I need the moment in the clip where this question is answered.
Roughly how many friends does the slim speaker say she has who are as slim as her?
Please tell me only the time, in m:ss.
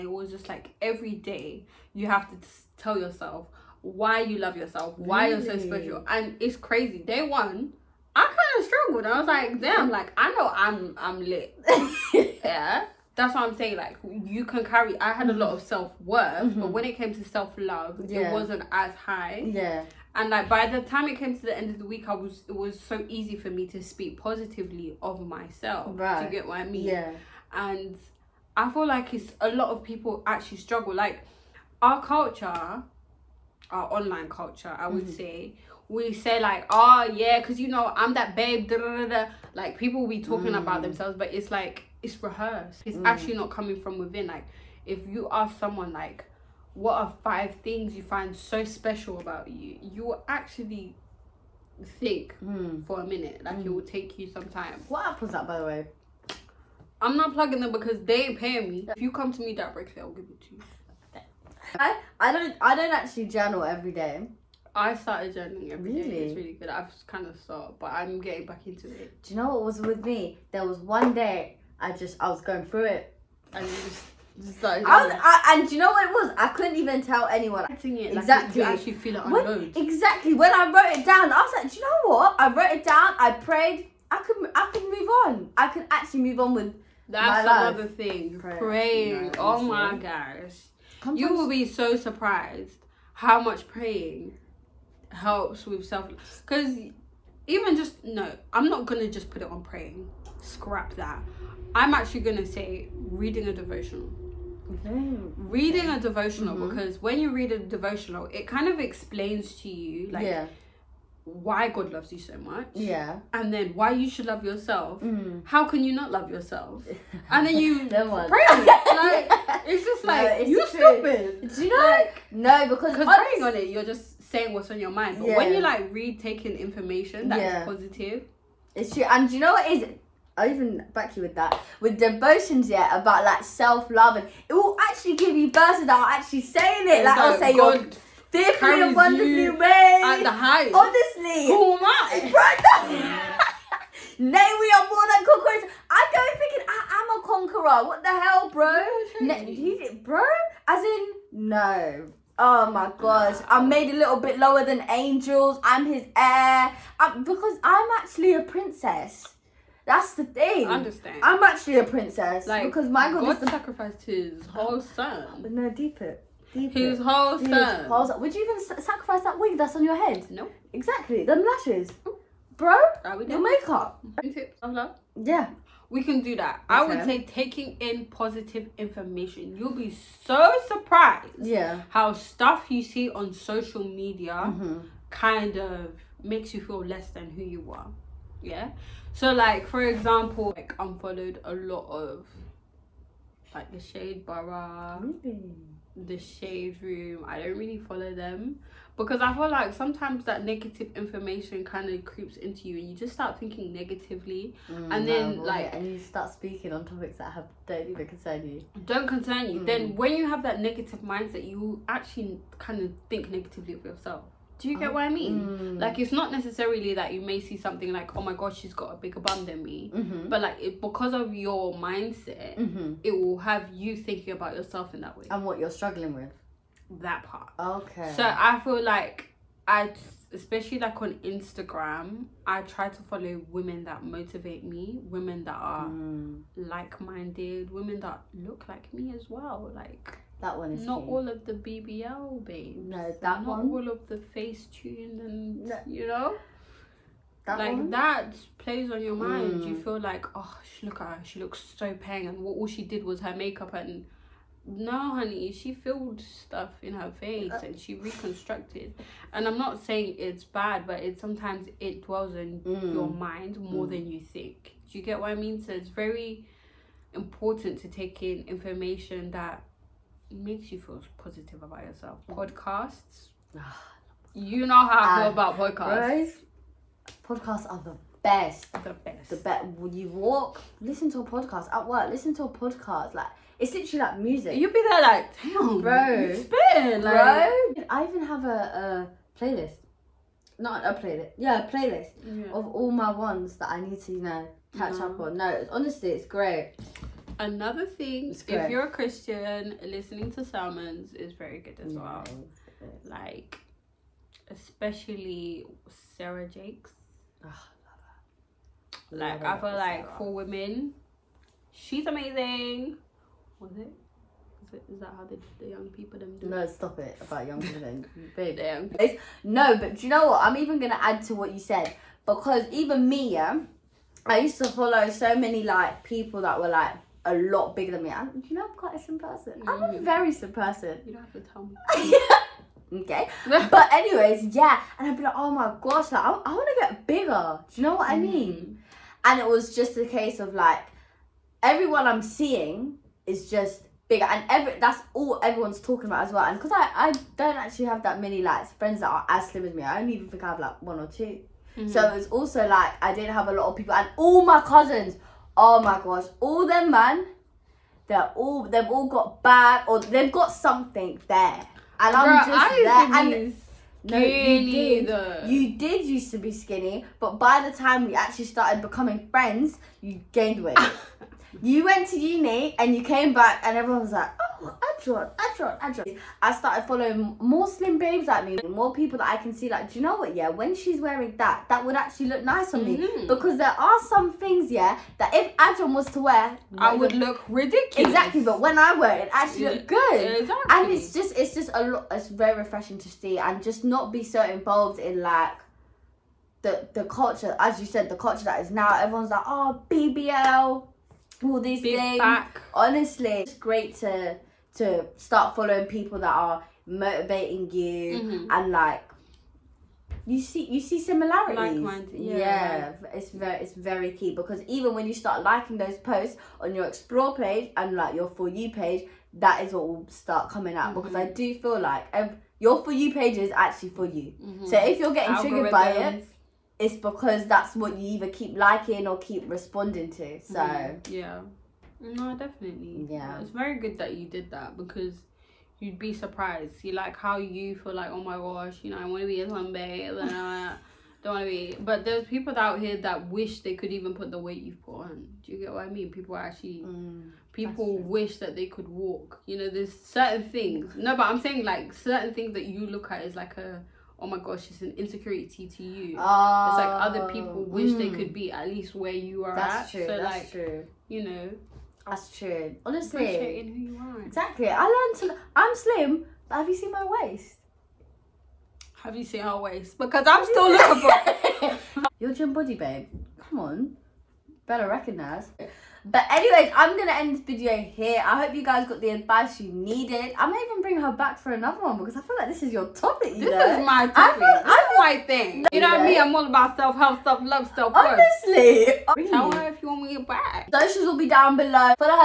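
5:50.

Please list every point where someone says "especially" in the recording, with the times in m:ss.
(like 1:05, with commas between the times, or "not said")
3:50, 5:04.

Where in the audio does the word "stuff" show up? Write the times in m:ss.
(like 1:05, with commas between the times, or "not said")
3:02, 4:16.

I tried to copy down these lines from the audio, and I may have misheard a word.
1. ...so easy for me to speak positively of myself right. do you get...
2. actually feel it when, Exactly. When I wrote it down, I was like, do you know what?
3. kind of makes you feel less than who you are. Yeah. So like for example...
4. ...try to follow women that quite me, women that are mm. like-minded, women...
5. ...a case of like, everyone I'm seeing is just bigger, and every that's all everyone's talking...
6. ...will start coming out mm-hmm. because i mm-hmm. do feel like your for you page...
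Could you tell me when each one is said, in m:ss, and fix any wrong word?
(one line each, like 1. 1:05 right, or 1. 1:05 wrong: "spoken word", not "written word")
1. 0:22 right
2. 1:18 right
3. 3:05 right
4. 3:52 wrong: "motivate", not "quite"
5. 5:39 right
6. 6:59 right.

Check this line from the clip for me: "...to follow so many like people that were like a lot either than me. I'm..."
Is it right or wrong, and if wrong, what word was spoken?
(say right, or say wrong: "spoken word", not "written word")
wrong: "bigger", not "either".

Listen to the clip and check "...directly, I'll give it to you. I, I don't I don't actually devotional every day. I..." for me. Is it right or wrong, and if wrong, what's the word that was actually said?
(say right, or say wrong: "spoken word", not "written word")
wrong: "journal", not "devotional".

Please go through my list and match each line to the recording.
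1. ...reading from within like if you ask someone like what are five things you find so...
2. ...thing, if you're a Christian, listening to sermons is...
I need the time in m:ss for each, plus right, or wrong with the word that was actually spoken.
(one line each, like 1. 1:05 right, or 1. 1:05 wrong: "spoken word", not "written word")
1. 0:43 wrong: "coming", not "reading"
2. 4:57 right.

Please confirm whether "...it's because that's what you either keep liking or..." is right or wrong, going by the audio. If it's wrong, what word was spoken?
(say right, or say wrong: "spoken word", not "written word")
right.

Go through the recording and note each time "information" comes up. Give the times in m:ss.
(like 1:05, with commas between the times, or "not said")
2:06, 2:58, 3:20, 4:28.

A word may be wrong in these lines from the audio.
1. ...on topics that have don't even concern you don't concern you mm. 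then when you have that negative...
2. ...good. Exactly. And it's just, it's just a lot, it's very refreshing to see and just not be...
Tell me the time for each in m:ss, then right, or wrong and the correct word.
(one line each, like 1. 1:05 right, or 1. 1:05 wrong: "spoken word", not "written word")
1. 3:26 right
2. 6:29 right.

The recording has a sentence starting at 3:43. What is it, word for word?
it will have you thinking about yourself in that way and what you're struggling with.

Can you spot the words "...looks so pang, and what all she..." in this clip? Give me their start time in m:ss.
4:11.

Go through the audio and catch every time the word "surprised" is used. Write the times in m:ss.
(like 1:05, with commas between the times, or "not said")
1:31, 3:00, 7:16.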